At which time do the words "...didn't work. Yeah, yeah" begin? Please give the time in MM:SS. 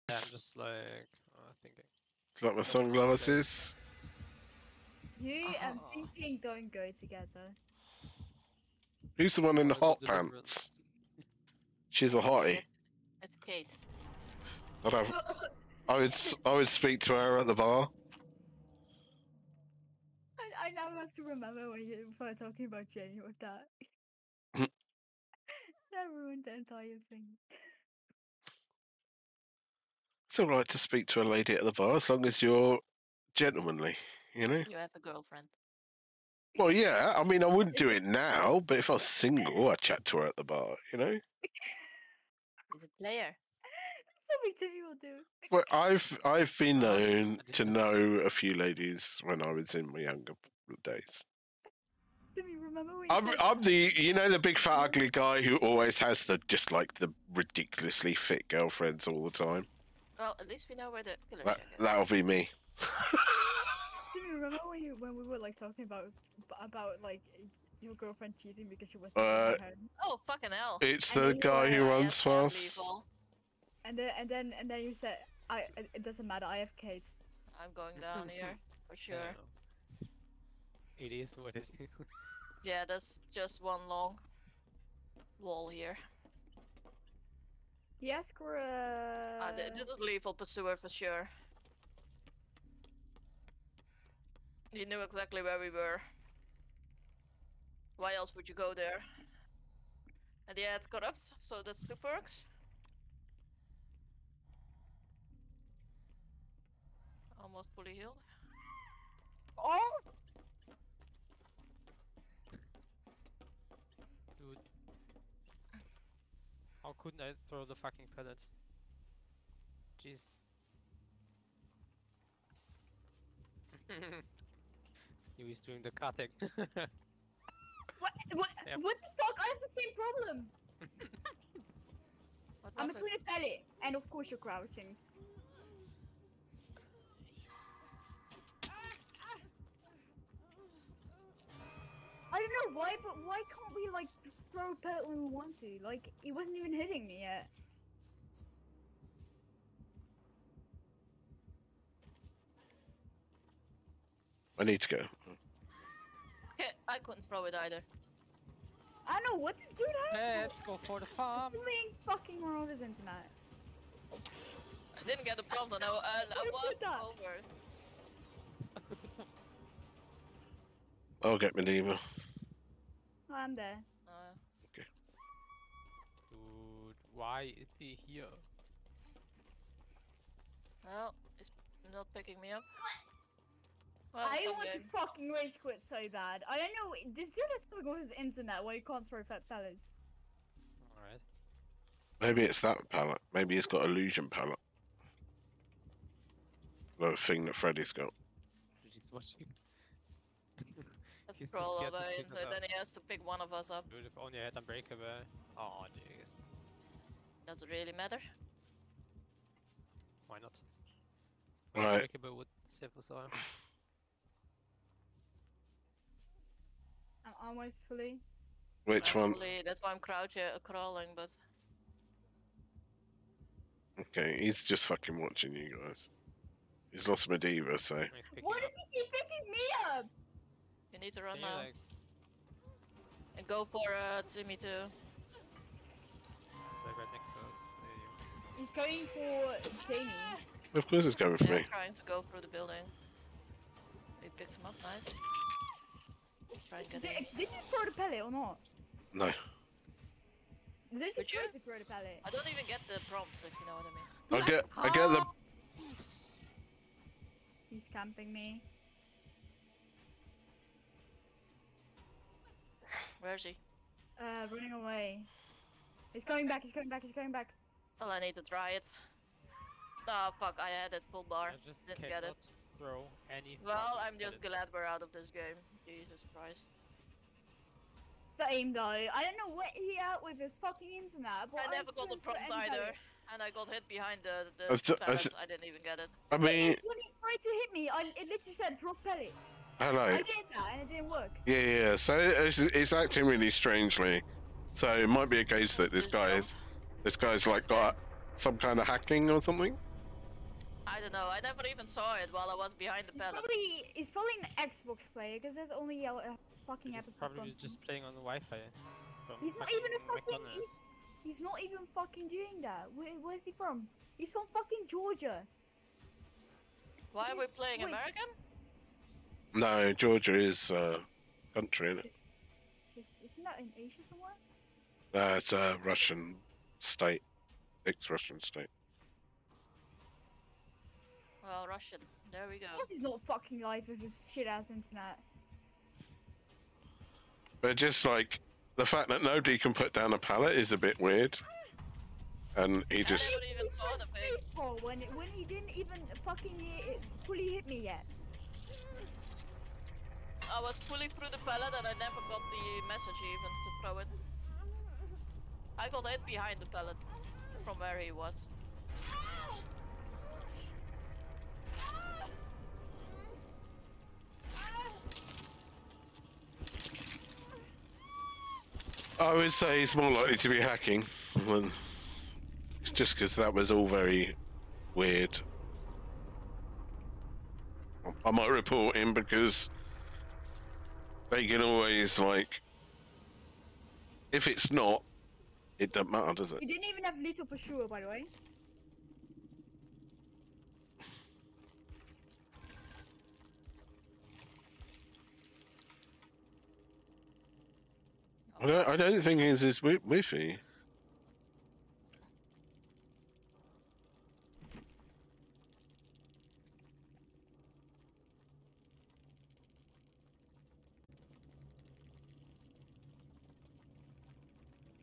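04:50.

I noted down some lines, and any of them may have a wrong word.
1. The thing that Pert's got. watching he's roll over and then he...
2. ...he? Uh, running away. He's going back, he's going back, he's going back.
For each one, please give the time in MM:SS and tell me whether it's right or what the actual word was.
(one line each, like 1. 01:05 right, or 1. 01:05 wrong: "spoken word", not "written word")
1. 03:16 wrong: "Freddy", not "Pert"
2. 04:23 right.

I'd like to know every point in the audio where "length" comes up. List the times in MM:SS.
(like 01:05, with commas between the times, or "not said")
not said.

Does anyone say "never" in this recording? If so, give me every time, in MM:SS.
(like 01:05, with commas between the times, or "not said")
04:41, 05:01, 05:51.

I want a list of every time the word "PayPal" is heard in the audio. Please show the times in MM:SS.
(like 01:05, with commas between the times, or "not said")
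not said.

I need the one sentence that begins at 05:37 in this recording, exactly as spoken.
But just like the fact that nobody can put down a pallet is a bit weird.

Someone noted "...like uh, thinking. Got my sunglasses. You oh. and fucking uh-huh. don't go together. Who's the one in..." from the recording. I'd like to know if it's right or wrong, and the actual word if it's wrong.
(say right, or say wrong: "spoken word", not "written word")
wrong: "thinking", not "fucking".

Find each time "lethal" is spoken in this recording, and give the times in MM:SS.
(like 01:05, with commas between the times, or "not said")
01:30.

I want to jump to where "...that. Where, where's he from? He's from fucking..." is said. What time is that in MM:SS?
05:12.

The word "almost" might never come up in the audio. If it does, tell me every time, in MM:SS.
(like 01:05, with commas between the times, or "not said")
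01:47, 03:37.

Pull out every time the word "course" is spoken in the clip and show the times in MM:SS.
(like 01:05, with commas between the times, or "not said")
02:14, 04:00, 05:32.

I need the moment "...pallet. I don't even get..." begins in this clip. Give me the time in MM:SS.
04:11.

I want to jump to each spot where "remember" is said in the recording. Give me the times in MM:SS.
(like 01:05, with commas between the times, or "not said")
00:21, 00:52, 01:04.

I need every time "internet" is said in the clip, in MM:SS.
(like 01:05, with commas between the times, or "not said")
02:42, 03:08, 04:40, 05:34.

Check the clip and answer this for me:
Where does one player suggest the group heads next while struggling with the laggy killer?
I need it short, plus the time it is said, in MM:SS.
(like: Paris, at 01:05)
the farm, at 02:40.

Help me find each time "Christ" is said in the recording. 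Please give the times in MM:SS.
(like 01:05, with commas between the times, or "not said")
04:36.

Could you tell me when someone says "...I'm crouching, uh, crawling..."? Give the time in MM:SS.
03:39.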